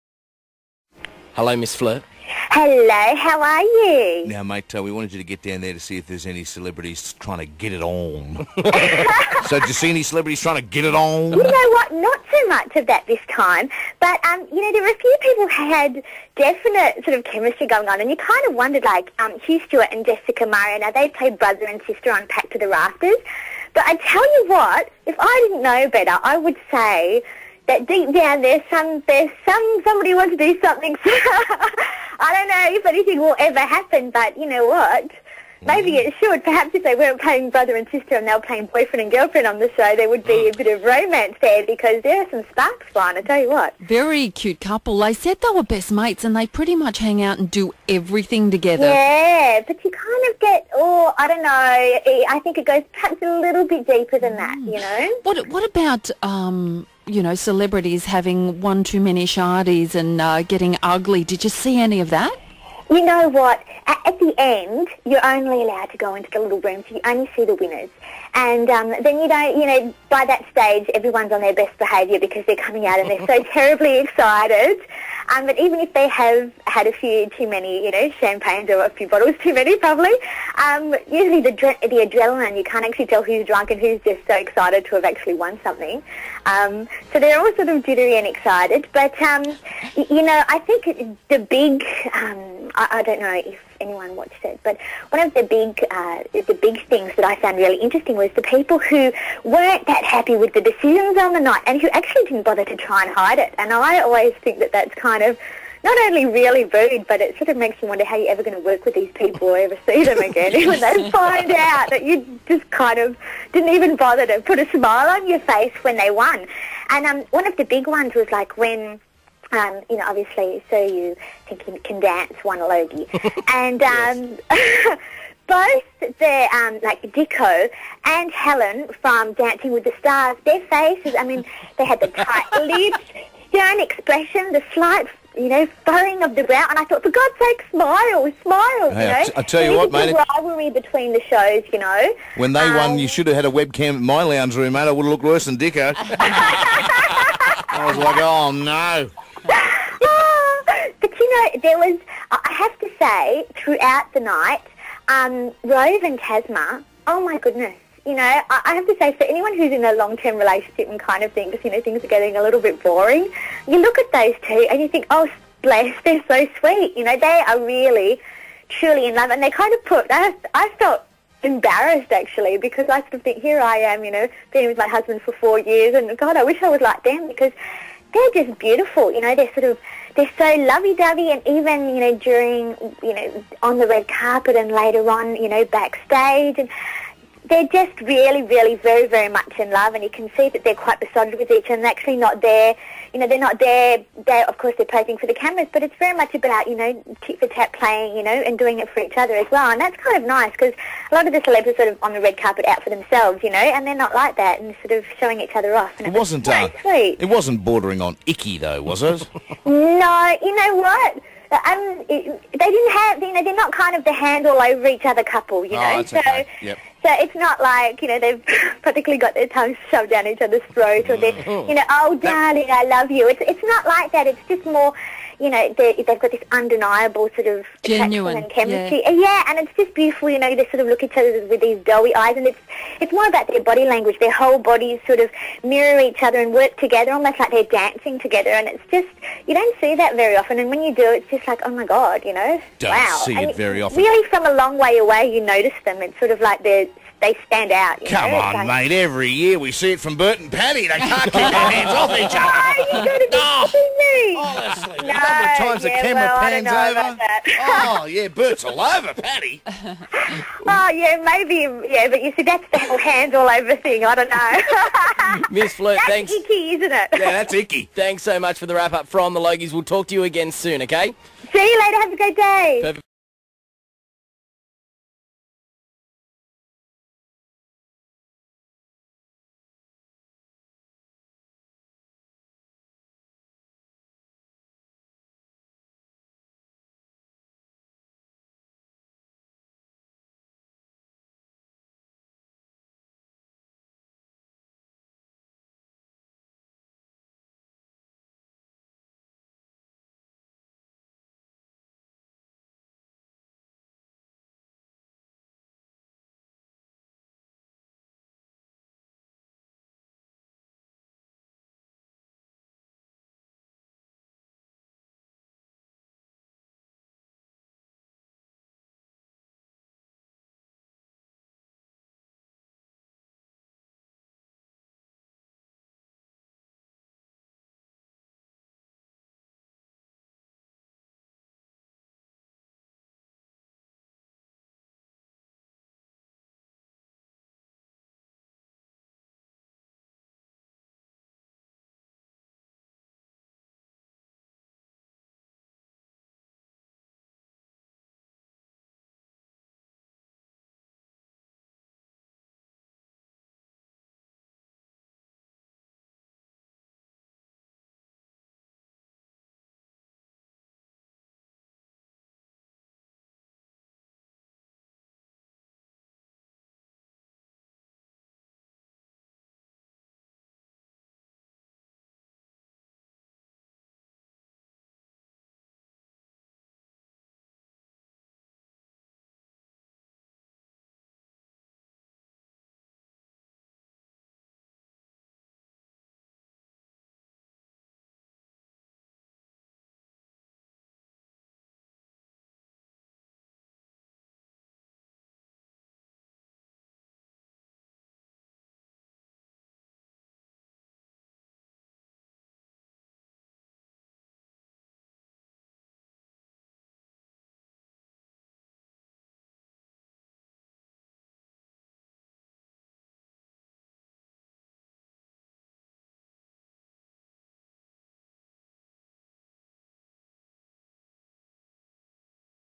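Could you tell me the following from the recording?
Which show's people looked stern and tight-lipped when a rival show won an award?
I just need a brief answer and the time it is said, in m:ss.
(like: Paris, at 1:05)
Dancing with the Stars, at 2:09.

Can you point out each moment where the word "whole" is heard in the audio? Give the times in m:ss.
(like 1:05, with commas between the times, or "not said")
3:54, 4:22.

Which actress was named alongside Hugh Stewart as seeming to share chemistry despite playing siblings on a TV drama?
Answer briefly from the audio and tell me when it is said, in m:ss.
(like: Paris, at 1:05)
Jessica Marais, at 0:20.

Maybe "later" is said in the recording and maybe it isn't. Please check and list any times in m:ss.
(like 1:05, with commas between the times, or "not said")
3:04, 4:31.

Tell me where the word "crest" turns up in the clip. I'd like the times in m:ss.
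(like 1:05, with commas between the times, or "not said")
not said.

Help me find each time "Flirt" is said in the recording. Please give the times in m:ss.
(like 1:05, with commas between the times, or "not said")
0:01, 4:25.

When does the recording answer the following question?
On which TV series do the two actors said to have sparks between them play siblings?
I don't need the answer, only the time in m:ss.
0:22.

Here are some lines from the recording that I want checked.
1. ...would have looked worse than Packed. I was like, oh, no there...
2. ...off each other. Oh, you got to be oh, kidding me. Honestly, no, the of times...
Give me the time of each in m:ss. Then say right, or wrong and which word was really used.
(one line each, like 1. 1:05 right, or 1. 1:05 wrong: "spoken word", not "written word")
1. 2:24 wrong: "Dicker", not "Packed"
2. 4:11 right.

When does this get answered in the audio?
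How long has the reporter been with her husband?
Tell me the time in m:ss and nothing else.
2:55.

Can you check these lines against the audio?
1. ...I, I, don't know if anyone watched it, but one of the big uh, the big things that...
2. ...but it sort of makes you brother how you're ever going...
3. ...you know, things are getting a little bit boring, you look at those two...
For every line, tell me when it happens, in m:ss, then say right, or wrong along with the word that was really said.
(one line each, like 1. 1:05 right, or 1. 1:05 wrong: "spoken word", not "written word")
1. 1:32 right
2. 1:47 wrong: "wonder", not "brother"
3. 2:41 right.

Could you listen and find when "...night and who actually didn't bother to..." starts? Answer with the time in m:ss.
1:41.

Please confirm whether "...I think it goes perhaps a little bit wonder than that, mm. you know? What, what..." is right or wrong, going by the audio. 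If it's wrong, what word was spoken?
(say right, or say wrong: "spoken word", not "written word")
wrong: "deeper", not "wonder".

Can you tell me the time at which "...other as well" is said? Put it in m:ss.
3:19.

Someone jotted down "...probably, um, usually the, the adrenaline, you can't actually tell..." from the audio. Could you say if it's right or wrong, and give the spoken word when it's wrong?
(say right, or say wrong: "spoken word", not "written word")
right.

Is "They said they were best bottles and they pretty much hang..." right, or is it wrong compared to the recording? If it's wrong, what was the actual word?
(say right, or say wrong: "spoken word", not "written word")
wrong: "mates", not "bottles".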